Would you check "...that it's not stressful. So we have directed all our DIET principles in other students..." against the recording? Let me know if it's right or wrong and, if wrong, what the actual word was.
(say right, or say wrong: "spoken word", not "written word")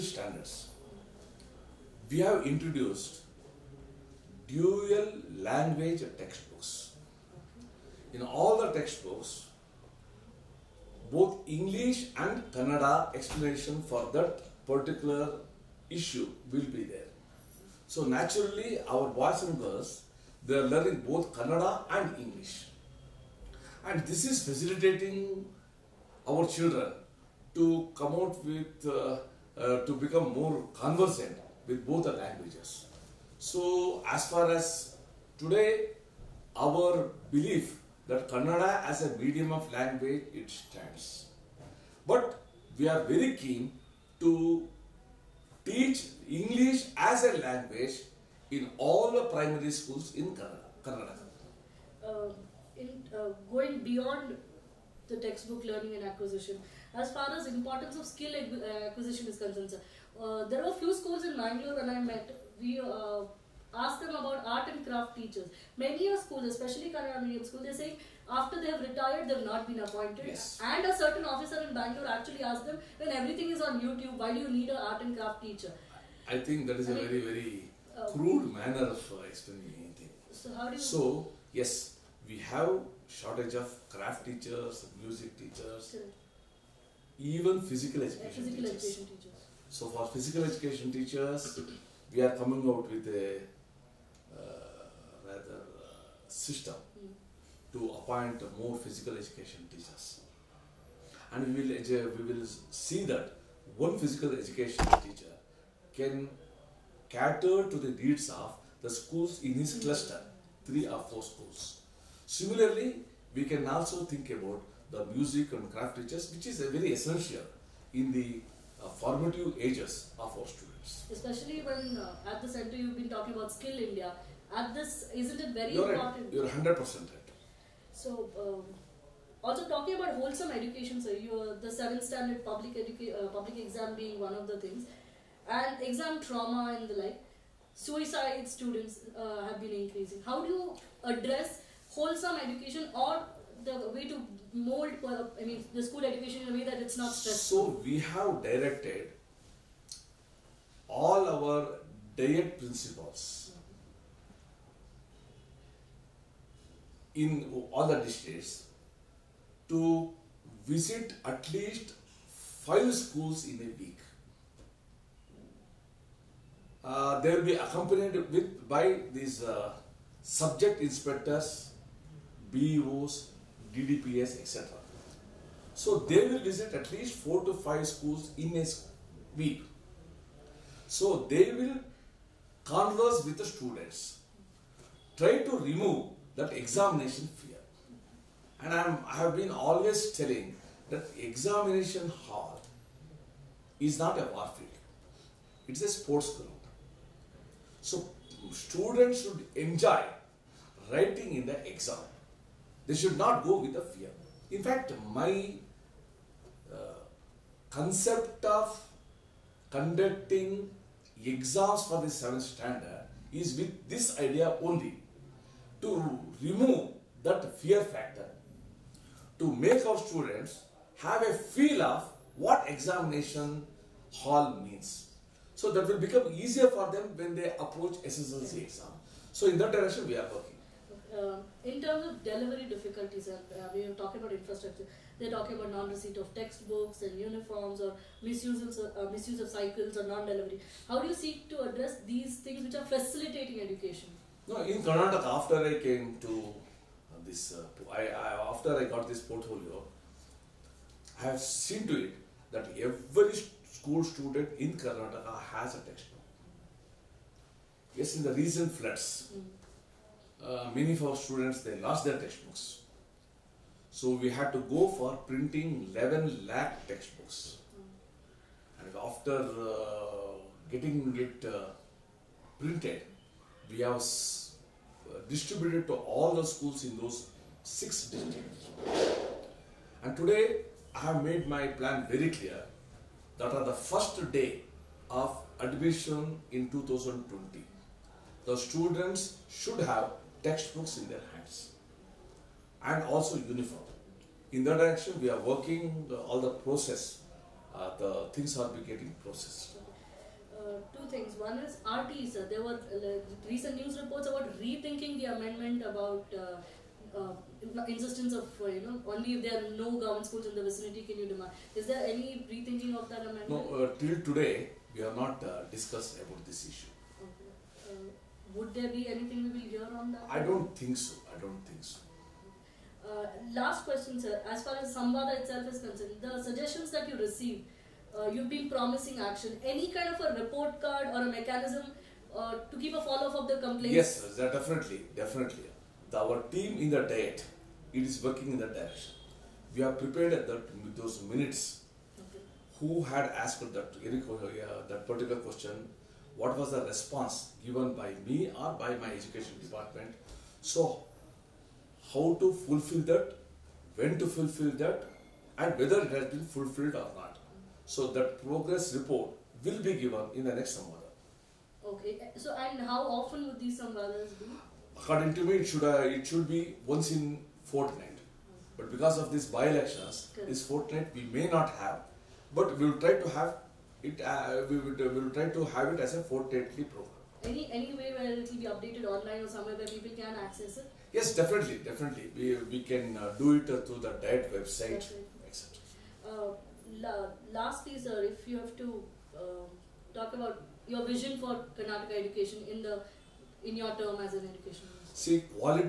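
wrong: "districts", not "students".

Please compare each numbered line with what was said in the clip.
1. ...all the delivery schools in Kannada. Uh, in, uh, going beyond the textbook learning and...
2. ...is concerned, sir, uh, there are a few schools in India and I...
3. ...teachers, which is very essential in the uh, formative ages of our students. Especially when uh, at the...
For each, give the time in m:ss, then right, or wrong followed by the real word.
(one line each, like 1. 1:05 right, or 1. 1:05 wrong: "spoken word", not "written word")
1. 0:48 wrong: "primary", not "delivery"
2. 0:59 wrong: "Bangalore", not "India"
3. 1:55 right.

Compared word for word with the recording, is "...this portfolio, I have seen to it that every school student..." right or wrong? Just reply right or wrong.
right.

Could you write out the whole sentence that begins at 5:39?
We have prepared that, those minutes.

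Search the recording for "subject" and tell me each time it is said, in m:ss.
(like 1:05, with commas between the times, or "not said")
2:50.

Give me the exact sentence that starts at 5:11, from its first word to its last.
Is there any rethinking of that amendment?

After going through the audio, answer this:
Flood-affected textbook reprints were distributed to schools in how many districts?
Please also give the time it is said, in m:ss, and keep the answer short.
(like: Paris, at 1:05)
6, at 4:37.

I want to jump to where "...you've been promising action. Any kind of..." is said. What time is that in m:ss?
5:28.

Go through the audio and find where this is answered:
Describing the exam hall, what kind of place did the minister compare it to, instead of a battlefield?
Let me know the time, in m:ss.
3:15.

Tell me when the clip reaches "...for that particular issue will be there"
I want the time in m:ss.
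0:13.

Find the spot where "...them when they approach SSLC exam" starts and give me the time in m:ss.
3:46.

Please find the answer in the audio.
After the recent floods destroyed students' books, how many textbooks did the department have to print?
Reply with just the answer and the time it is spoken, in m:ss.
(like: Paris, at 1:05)
11 lakh, at 4:25.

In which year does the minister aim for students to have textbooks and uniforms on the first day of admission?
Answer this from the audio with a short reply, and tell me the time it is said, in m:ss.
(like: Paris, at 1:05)
2020, at 4:46.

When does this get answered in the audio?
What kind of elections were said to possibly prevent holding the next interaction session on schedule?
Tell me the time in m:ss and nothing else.
6:09.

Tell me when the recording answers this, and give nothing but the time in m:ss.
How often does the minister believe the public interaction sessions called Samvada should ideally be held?
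6:06.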